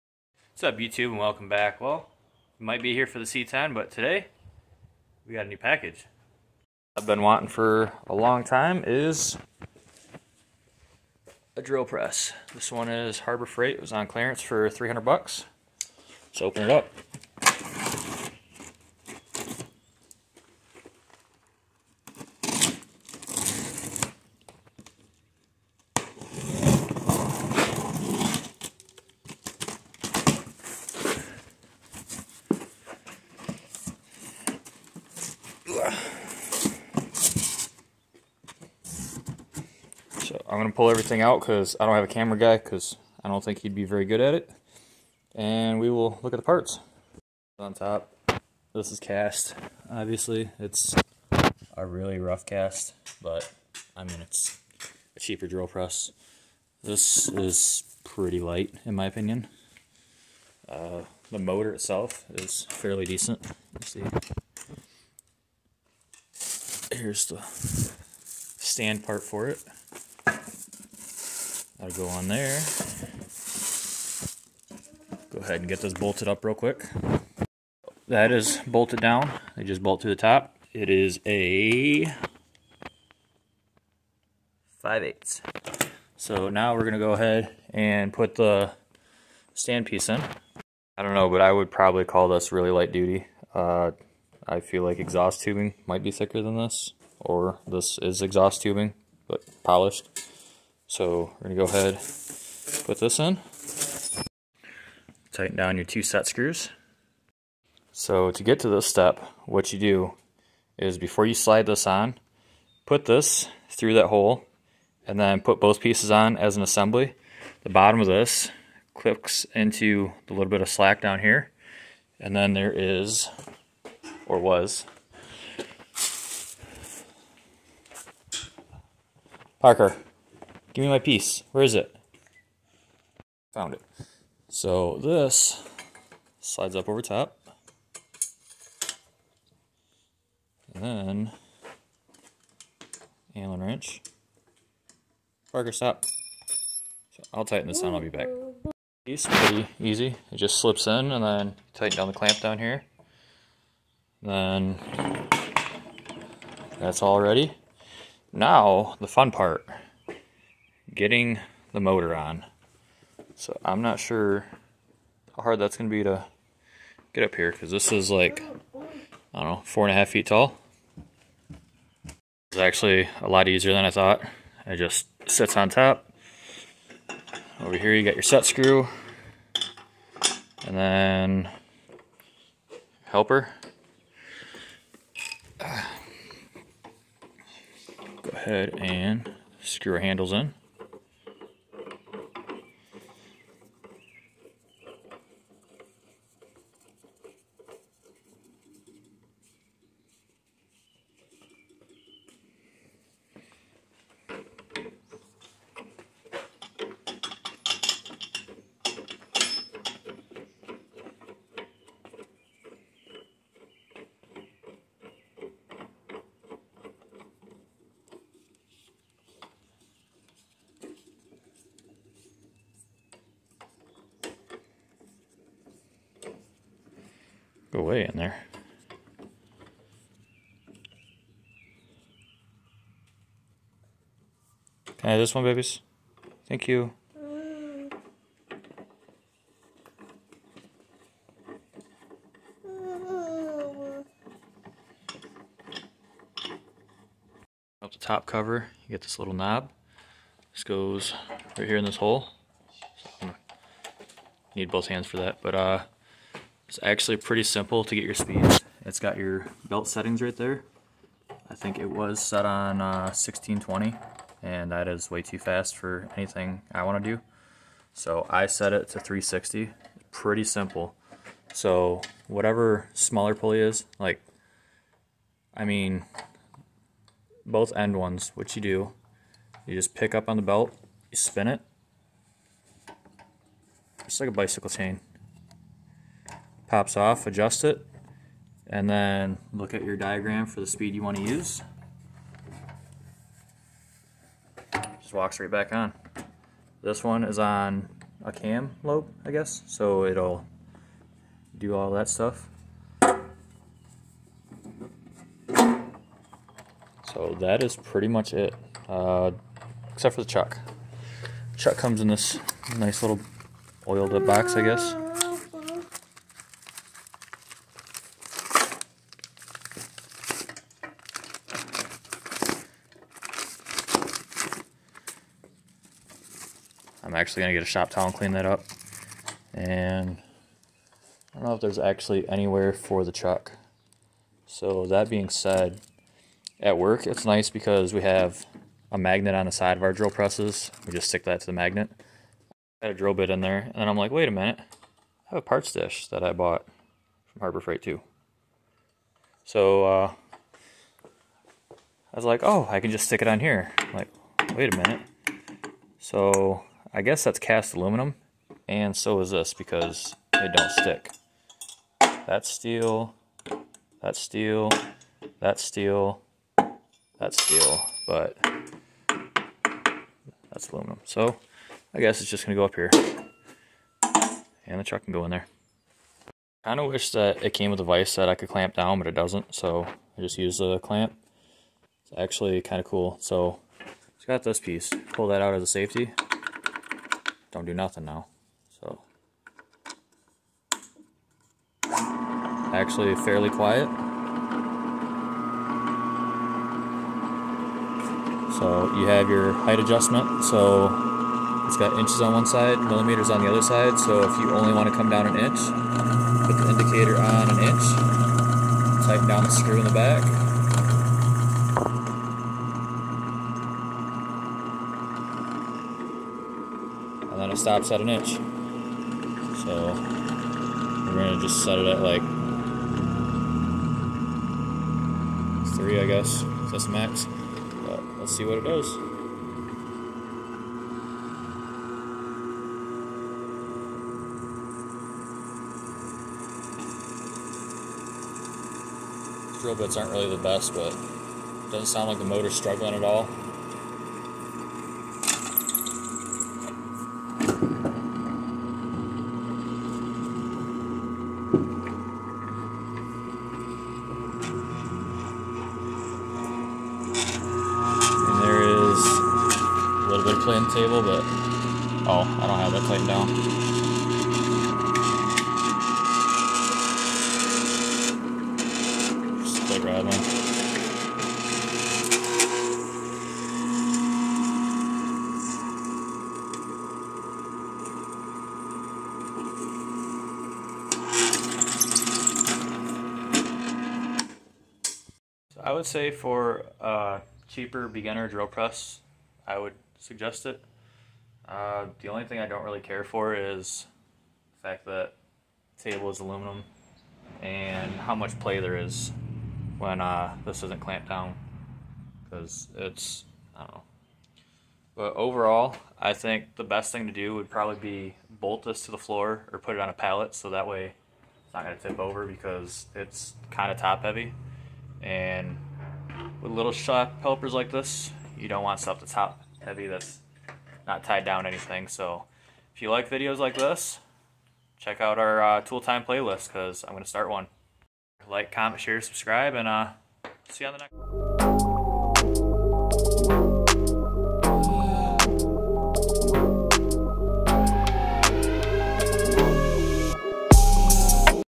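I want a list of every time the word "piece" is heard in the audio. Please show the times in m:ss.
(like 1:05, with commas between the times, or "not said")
1:29, 1:55, 2:10, 6:24.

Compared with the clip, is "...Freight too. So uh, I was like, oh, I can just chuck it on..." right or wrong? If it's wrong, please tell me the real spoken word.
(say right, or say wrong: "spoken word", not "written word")
wrong: "stick", not "chuck".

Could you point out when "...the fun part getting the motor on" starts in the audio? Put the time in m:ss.
2:39.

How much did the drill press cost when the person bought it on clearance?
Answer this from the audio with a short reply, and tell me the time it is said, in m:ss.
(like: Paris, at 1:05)
$300, at 0:14.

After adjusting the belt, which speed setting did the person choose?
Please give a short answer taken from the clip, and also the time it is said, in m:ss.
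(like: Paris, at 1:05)
360, at 4:29.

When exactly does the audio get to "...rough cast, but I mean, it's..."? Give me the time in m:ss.
0:52.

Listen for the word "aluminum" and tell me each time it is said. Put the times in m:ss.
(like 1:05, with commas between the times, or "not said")
5:57, 6:10, 8:16.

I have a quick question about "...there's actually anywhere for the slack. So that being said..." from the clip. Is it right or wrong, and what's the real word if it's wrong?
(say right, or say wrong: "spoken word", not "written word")
wrong: "chuck", not "slack".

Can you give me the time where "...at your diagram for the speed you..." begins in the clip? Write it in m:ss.
4:49.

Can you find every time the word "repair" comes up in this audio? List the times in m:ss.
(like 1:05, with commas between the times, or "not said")
not said.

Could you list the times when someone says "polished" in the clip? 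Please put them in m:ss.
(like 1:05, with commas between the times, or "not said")
1:39.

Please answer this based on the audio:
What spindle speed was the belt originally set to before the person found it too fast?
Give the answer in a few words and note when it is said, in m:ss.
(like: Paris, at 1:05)
1620, at 4:23.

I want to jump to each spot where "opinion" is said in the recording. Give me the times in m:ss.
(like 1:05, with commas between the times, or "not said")
0:59.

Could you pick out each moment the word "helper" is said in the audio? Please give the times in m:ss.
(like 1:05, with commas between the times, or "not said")
3:03, 8:37.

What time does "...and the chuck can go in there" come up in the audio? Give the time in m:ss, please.
6:14.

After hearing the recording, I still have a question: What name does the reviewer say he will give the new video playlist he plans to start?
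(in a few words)
tool time.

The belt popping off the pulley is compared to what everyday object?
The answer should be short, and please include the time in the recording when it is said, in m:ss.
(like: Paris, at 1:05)
bicycle chain, at 4:44.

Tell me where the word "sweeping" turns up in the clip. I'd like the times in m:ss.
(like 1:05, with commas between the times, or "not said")
not said.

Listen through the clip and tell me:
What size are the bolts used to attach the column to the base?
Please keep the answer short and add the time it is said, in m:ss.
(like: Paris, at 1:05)
5/8, at 1:24.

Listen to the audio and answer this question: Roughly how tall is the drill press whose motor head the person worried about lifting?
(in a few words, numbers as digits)
4.5 feet.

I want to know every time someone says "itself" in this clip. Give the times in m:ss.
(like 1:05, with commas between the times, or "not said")
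1:01.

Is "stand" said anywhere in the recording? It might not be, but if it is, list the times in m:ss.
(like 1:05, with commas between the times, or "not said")
1:08, 1:29.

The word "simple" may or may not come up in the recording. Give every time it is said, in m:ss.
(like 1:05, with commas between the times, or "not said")
4:17, 4:30.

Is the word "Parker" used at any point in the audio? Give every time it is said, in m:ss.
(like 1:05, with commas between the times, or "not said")
2:09, 2:25.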